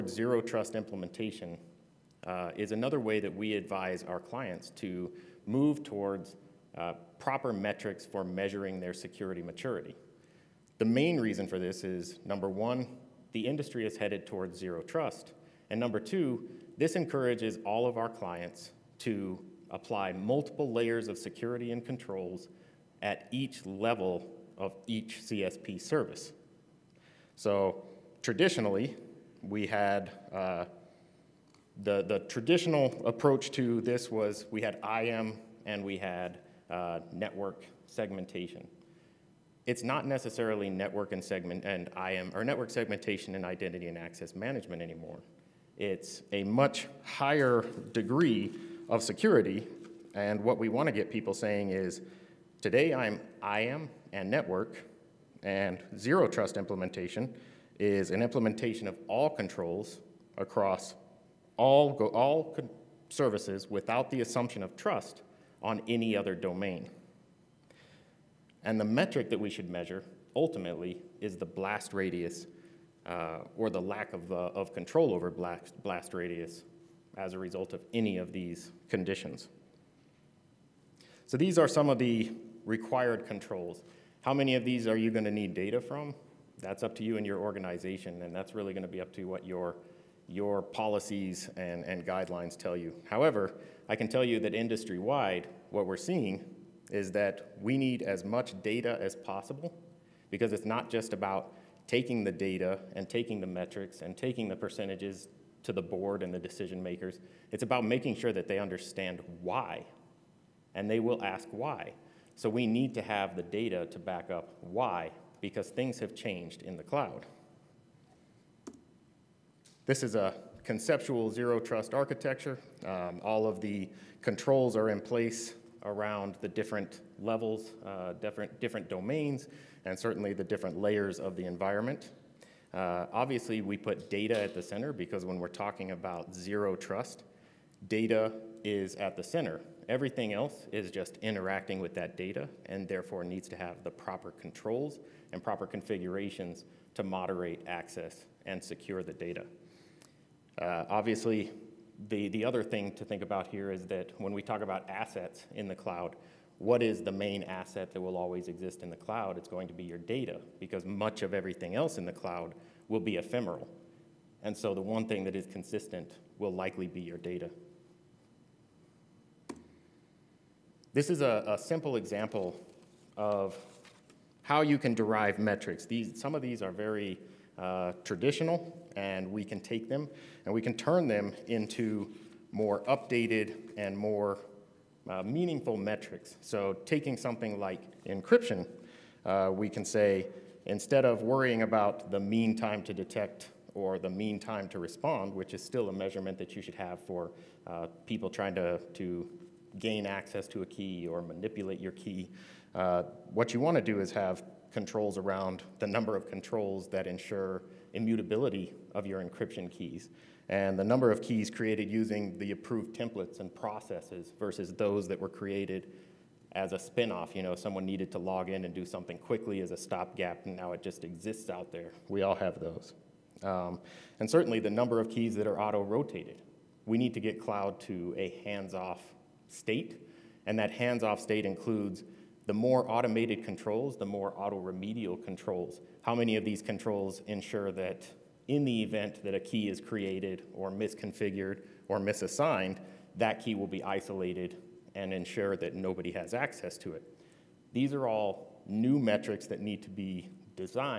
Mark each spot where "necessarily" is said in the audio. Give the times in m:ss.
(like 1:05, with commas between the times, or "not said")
0:40.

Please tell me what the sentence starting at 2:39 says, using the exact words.
It's going to be your data because much of everything else in the cloud will be ephemeral.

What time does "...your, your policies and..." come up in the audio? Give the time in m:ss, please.
1:29.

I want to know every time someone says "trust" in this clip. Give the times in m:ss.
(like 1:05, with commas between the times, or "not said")
0:00, 0:14, 0:56, 1:04, 2:01, 2:16.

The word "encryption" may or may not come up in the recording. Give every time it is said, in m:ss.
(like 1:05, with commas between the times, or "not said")
3:08, 3:29.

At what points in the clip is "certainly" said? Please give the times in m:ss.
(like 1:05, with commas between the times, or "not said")
2:09, 3:44.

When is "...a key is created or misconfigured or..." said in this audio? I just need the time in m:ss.
3:59.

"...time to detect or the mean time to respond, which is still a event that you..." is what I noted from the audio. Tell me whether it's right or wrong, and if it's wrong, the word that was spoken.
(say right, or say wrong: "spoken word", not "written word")
wrong: "measurement", not "event".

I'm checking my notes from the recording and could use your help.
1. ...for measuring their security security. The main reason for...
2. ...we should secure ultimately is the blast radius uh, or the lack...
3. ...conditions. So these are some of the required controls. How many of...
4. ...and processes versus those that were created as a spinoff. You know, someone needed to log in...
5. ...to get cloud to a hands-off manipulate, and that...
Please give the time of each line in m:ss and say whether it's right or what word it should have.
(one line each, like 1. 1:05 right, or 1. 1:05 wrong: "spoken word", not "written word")
1. 0:08 wrong: "maturity", not "security"
2. 1:09 wrong: "measure", not "secure"
3. 1:18 right
4. 3:33 right
5. 3:47 wrong: "state", not "manipulate".